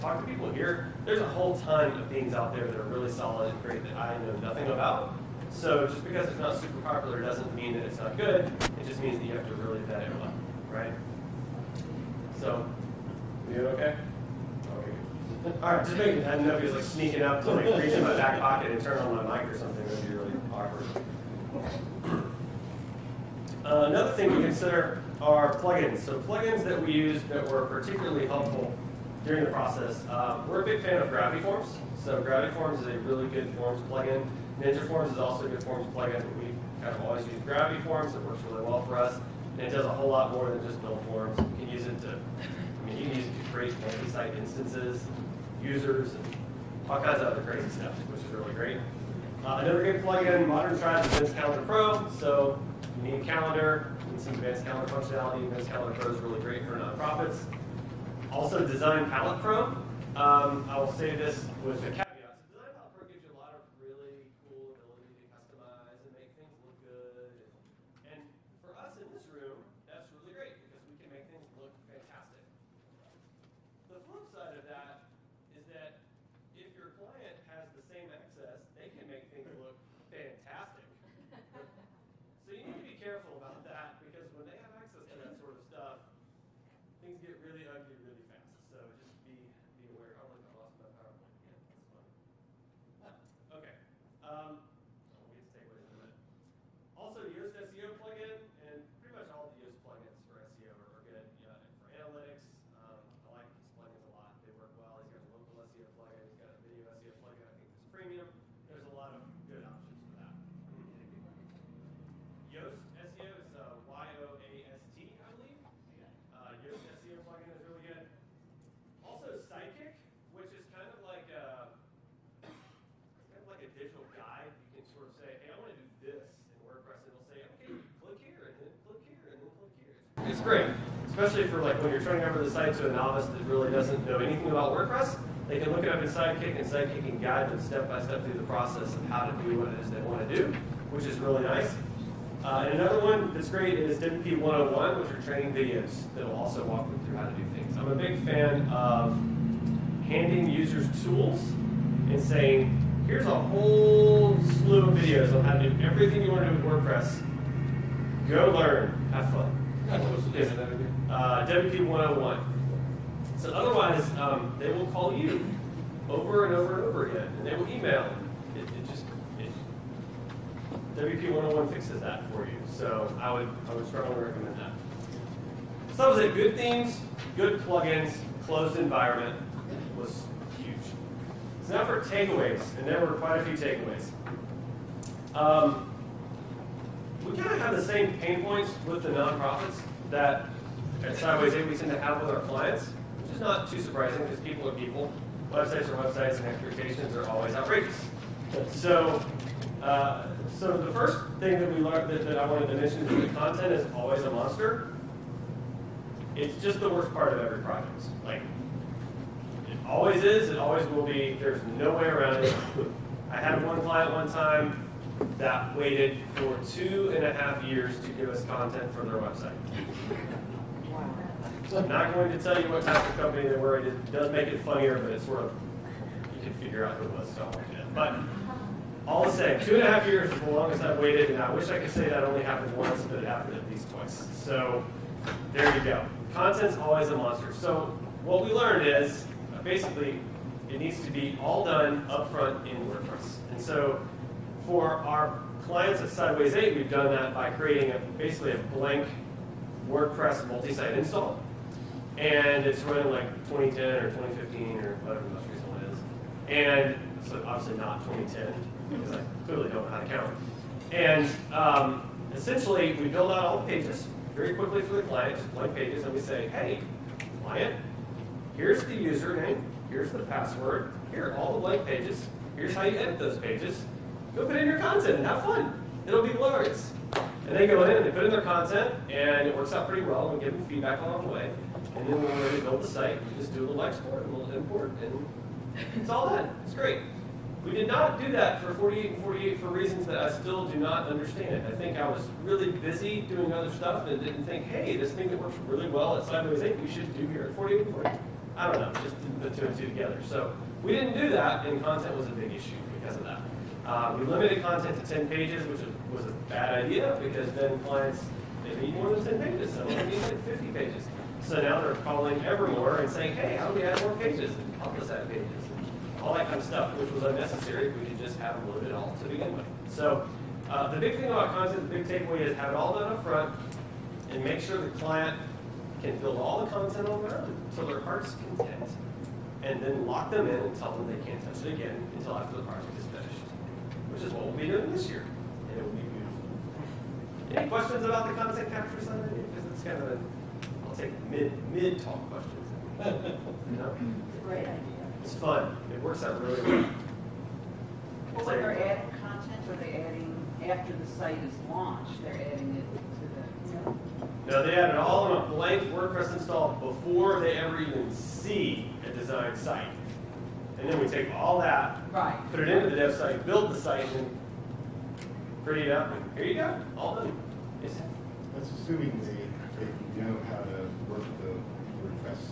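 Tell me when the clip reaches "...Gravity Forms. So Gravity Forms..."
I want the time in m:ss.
0:31.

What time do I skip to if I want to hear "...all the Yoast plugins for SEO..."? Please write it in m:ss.
1:39.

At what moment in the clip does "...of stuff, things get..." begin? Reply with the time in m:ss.
1:25.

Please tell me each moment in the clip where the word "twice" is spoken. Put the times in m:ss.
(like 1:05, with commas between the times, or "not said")
3:53.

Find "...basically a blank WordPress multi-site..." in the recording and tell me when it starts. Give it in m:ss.
4:08.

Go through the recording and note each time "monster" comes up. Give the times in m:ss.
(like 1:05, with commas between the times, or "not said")
3:24, 3:57.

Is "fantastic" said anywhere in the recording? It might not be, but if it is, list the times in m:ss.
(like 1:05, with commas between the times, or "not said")
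1:11, 1:20.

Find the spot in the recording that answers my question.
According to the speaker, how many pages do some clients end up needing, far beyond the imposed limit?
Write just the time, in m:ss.
5:10.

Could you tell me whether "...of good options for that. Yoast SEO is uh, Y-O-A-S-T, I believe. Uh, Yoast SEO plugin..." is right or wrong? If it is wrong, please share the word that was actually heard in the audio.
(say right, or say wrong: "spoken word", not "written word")
right.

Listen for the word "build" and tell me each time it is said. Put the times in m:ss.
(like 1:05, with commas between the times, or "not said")
0:40, 4:23, 4:42, 5:26, 6:03.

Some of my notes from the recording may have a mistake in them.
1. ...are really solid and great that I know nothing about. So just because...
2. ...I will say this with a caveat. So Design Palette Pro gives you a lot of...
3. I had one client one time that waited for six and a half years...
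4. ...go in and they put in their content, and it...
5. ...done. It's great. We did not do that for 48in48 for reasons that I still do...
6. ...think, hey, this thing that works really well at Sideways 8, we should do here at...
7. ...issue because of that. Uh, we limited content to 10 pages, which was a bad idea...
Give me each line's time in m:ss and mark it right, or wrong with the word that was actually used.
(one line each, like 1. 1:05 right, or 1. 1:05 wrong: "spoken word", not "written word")
1. 0:02 right
2. 1:00 right
3. 3:33 wrong: "two", not "six"
4. 4:37 right
5. 4:46 right
6. 4:54 right
7. 5:02 right.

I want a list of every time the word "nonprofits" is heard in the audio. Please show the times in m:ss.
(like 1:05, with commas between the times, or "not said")
0:56, 3:09.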